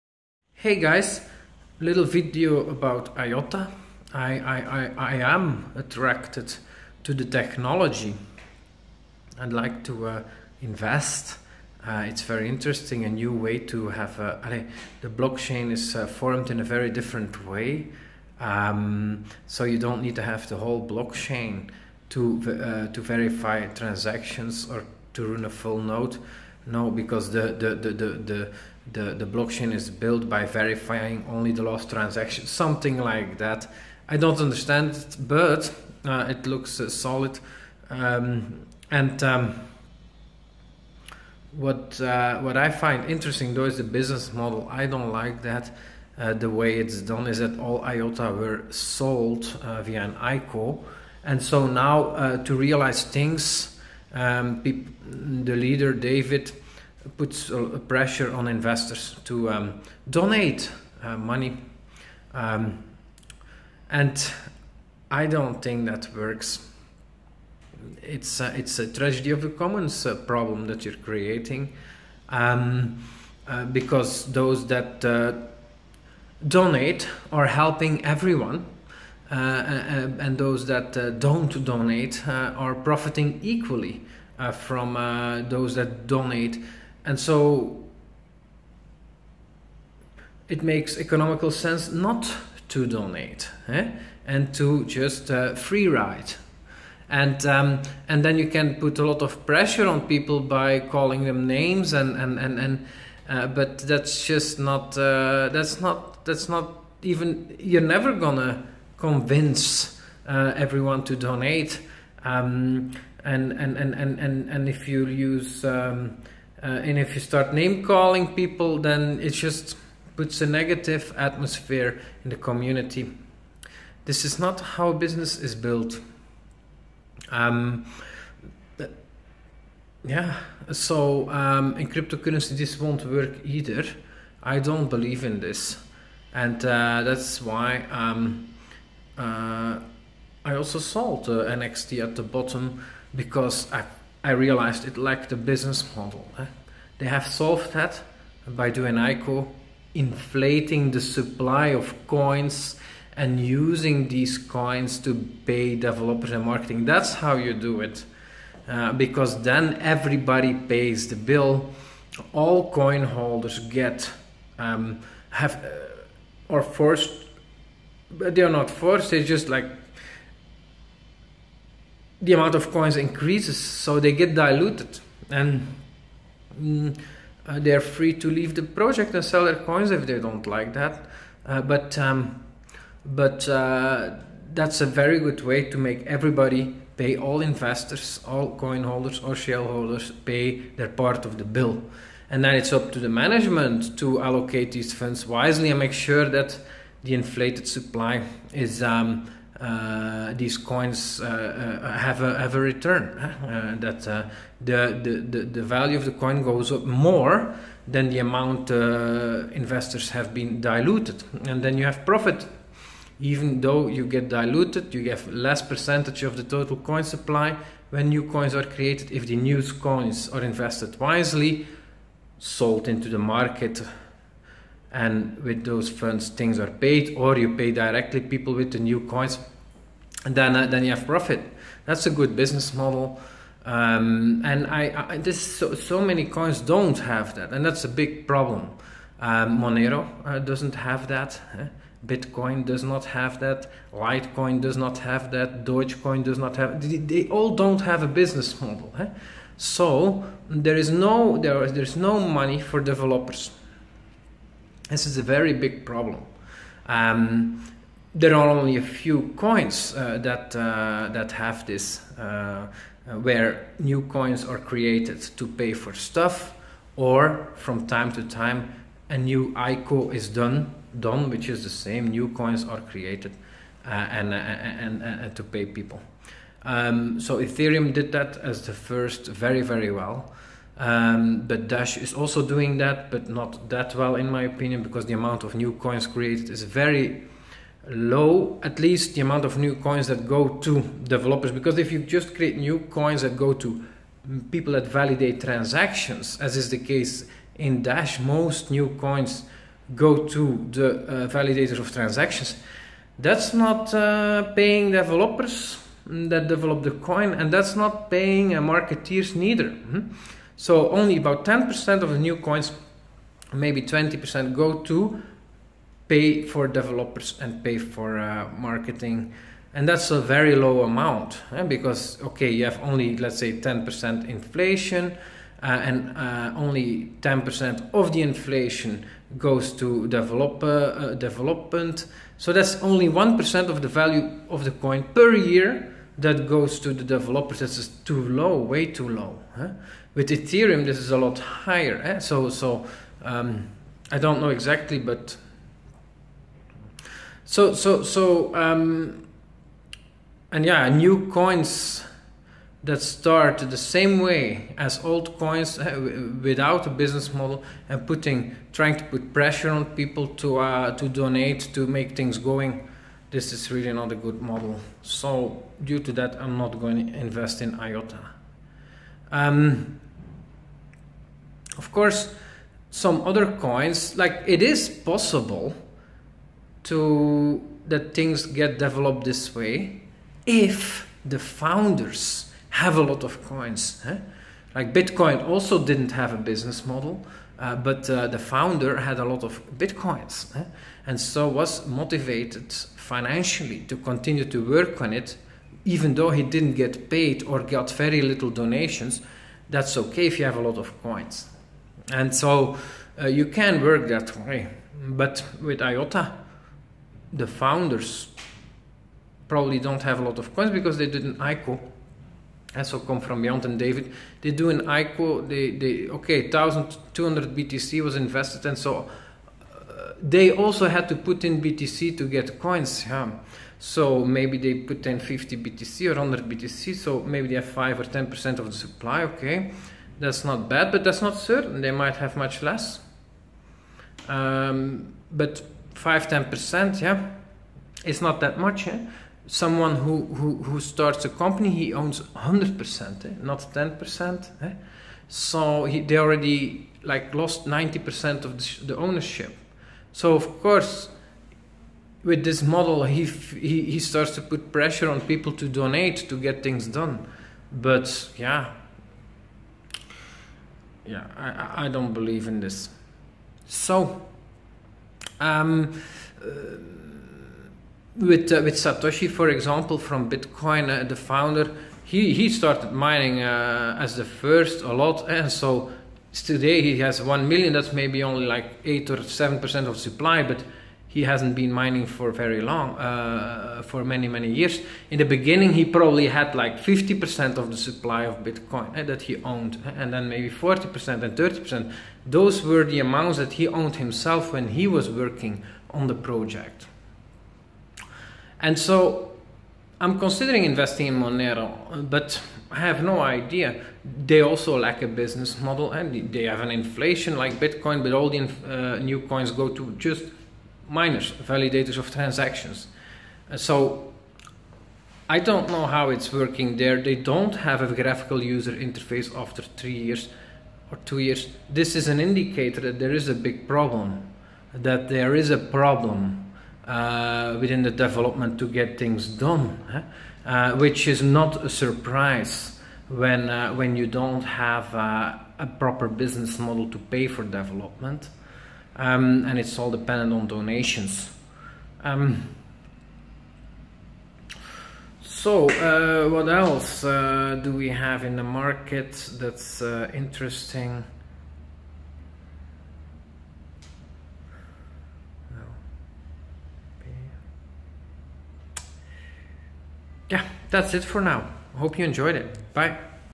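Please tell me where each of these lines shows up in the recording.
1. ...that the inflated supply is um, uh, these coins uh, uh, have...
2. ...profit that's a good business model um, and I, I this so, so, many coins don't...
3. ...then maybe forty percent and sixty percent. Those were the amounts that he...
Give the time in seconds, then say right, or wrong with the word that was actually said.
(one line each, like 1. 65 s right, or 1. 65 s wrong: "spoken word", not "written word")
1. 196 s right
2. 231 s right
3. 490 s wrong: "thirty", not "sixty".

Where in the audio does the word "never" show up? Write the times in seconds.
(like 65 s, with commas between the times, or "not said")
107 s.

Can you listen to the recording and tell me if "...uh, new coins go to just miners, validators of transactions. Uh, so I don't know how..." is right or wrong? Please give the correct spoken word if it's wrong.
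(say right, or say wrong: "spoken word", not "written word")
right.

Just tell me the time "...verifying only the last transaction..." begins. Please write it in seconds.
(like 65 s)
30 s.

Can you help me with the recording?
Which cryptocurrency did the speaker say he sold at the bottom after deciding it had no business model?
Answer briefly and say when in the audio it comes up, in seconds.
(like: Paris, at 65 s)
NXT, at 141 s.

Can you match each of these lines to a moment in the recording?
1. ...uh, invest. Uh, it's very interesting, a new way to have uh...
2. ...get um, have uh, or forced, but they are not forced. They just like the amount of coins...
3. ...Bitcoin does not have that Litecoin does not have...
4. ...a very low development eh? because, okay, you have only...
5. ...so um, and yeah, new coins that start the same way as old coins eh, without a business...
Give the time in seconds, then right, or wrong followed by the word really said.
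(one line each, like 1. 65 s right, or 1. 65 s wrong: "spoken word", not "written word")
1. 10 s right
2. 163 s right
3. 242 s right
4. 320 s wrong: "amount", not "development"
5. 348 s right.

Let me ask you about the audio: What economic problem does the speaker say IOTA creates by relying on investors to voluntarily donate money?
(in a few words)
Tragedy of the commons.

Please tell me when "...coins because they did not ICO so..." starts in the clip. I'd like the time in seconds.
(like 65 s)
410 s.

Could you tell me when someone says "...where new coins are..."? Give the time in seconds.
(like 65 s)
263 s.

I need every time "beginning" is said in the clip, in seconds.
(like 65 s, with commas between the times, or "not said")
485 s.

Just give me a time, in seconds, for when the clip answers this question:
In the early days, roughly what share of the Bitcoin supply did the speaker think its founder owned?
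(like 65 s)
486 s.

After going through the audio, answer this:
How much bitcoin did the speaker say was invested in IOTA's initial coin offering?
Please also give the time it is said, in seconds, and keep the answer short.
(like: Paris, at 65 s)
1,200 BTC, at 416 s.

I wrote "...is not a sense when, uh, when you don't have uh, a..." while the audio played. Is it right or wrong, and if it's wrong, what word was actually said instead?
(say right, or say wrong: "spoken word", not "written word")
wrong: "surprise", not "sense".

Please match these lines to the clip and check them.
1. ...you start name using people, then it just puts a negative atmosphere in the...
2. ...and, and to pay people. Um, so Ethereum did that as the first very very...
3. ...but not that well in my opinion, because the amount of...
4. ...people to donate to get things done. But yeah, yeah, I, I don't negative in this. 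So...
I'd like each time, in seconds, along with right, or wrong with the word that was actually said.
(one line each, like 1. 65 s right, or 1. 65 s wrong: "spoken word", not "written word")
1. 117 s wrong: "calling", not "using"
2. 274 s right
3. 283 s right
4. 455 s wrong: "believe", not "negative".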